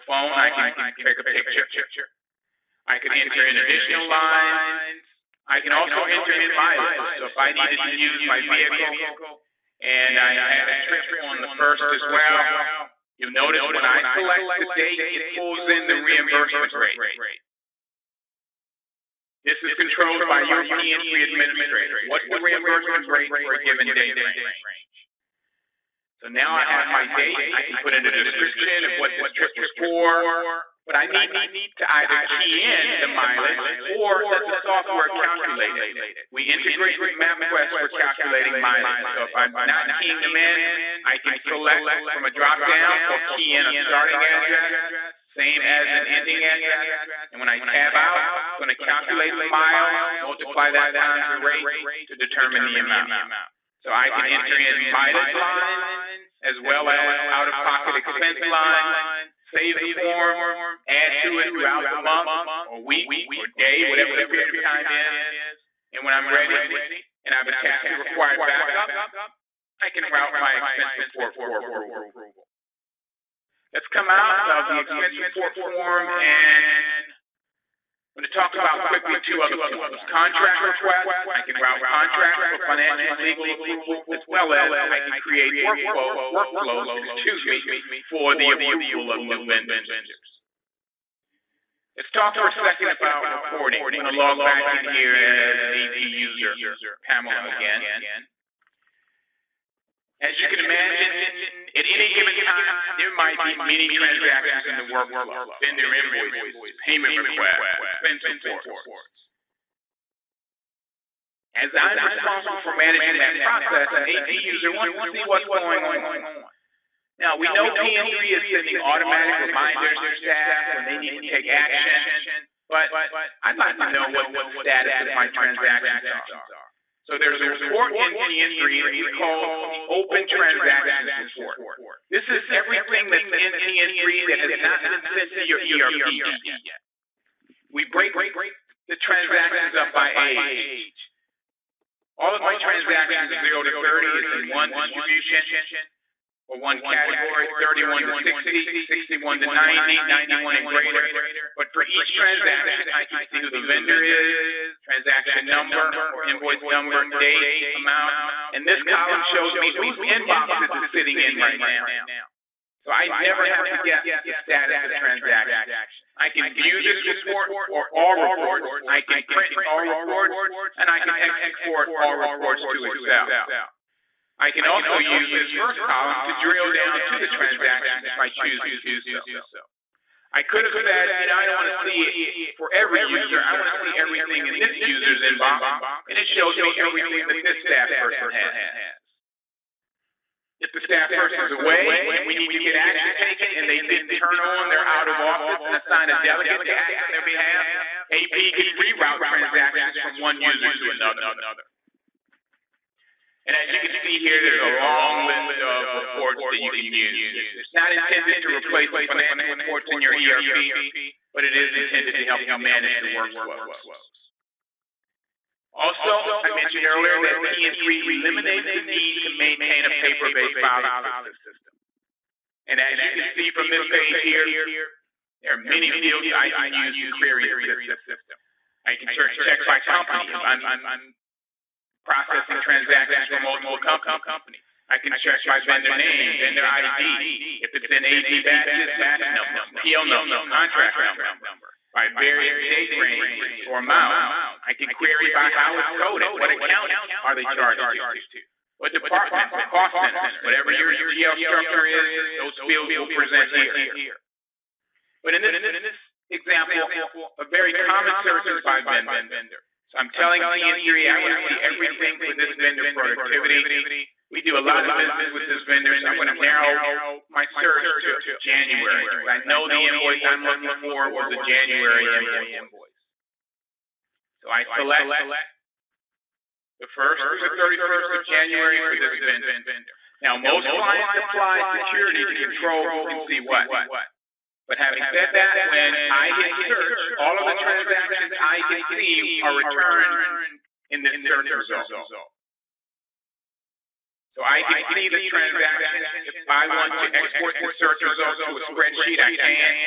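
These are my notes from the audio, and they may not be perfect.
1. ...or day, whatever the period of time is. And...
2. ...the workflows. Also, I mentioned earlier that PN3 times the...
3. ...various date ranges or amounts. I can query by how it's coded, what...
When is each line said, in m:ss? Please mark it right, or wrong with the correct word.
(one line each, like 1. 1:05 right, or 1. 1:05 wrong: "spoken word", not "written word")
1. 1:03 right
2. 3:33 wrong: "eliminates", not "times"
3. 4:02 right.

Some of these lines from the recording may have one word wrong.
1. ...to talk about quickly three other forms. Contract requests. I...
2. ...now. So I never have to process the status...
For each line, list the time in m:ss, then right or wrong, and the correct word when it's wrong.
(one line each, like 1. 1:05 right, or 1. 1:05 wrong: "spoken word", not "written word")
1. 1:18 wrong: "two", not "three"
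2. 2:41 wrong: "guess", not "process".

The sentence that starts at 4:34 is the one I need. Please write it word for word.
So I select the 1st through the 31st of January for this vendor.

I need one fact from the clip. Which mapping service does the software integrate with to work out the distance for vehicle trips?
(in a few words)
MapQuest.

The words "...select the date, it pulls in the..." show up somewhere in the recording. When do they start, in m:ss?
0:14.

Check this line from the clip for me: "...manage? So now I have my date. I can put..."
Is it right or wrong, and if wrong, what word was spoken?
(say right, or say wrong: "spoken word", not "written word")
wrong: "range", not "manage".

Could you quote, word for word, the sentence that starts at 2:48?
I can print all reports and I can export all reports to Excel.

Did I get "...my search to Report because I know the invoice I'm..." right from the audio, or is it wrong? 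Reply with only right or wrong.
wrong.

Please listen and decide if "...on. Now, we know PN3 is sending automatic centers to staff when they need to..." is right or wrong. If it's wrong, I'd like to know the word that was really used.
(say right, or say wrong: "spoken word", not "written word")
wrong: "reminders", not "centers".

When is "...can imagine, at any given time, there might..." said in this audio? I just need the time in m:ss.
1:40.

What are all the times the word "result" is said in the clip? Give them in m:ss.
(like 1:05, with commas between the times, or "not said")
4:51, 4:58.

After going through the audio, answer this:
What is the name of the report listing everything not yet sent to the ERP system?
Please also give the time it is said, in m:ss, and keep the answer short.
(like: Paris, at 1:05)
Open Transactions Report, at 2:09.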